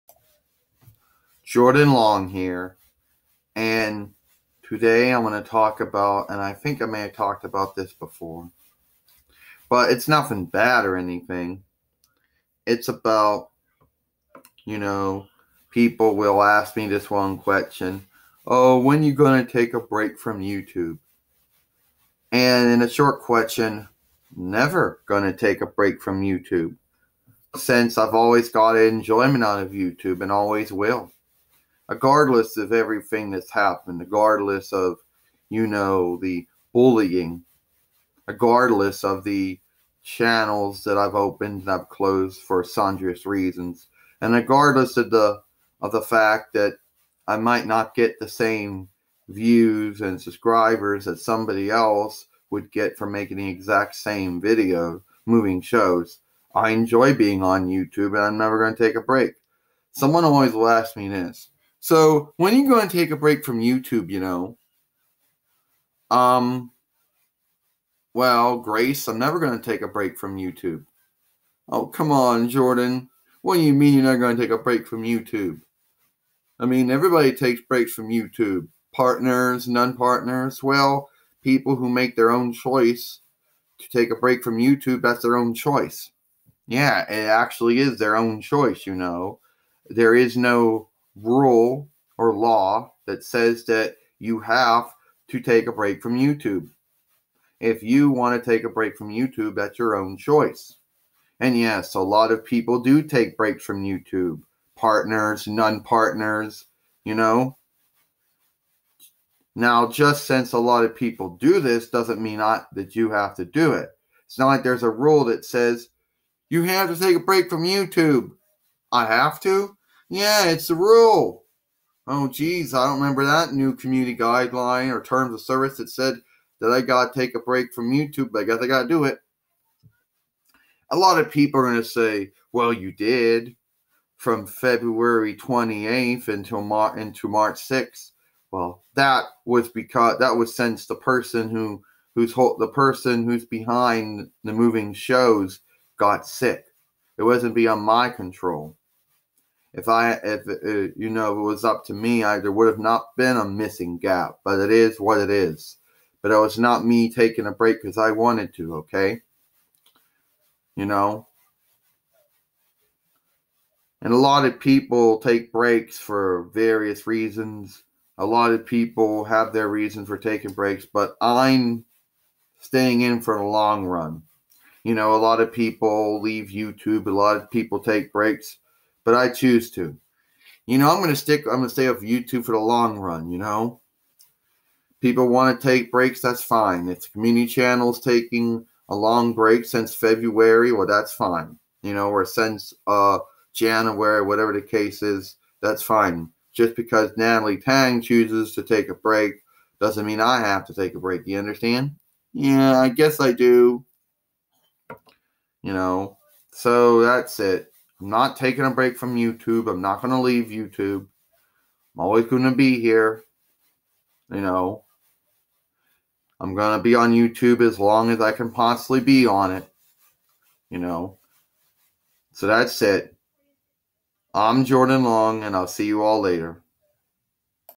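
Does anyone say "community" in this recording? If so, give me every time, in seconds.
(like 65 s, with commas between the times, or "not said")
123 s, 187 s.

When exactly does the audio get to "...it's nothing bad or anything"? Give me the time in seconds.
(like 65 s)
9 s.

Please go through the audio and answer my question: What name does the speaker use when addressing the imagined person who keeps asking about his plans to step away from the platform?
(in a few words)
Grace.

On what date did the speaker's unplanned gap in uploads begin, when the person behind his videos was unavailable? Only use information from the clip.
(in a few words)
February 28th.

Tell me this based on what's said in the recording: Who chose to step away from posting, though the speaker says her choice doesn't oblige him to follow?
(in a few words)
Natalie Tang.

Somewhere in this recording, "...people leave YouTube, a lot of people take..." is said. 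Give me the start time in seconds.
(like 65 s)
175 s.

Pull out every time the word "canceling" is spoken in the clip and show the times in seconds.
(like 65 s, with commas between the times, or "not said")
not said.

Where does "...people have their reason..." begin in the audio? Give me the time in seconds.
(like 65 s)
168 s.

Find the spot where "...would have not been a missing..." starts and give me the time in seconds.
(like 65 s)
152 s.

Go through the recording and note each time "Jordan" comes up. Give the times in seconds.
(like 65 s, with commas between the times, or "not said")
1 s, 72 s, 224 s.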